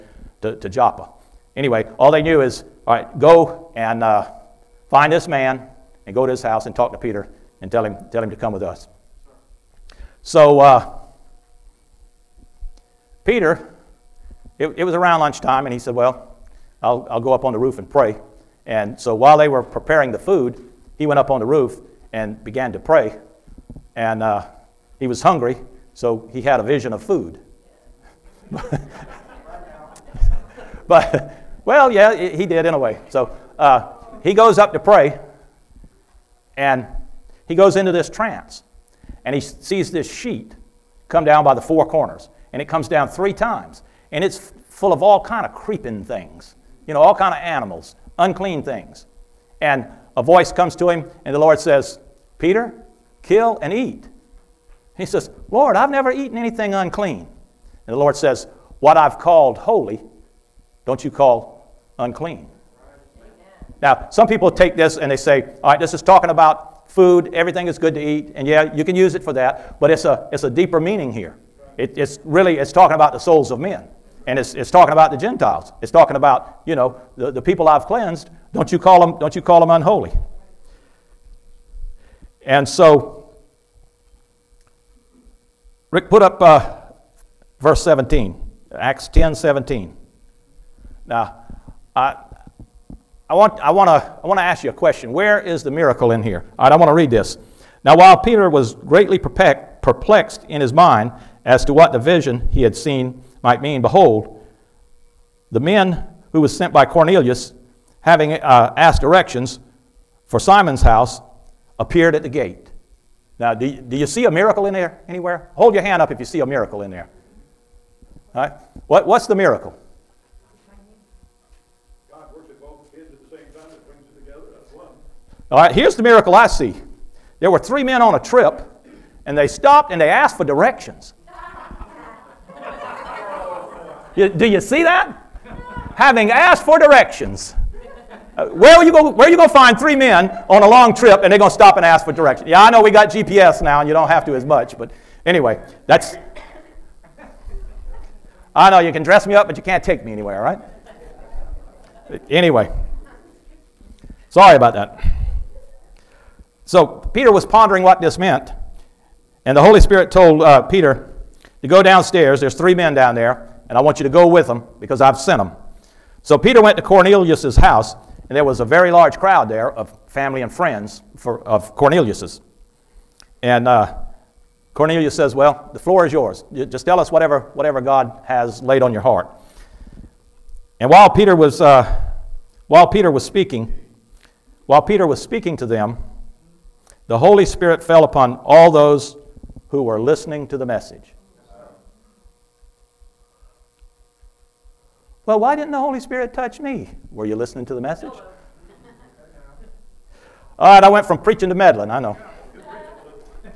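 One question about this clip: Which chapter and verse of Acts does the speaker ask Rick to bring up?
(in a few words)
Acts 10:17.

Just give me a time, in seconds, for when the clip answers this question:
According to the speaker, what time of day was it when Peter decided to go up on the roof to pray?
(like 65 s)
15 s.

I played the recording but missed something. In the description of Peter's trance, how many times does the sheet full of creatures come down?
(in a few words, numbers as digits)
3 times.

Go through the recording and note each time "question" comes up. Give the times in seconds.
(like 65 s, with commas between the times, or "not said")
94 s.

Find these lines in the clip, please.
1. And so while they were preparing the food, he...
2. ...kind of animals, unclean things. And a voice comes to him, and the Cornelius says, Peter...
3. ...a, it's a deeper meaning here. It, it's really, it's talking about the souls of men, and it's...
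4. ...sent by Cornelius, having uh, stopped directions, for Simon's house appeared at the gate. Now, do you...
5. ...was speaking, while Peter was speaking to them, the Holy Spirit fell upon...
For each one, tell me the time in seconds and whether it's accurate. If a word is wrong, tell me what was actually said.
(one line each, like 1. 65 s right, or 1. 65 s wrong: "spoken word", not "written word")
1. 18 s right
2. 47 s wrong: "Lord", not "Cornelius"
3. 70 s right
4. 106 s wrong: "asked", not "stopped"
5. 183 s right.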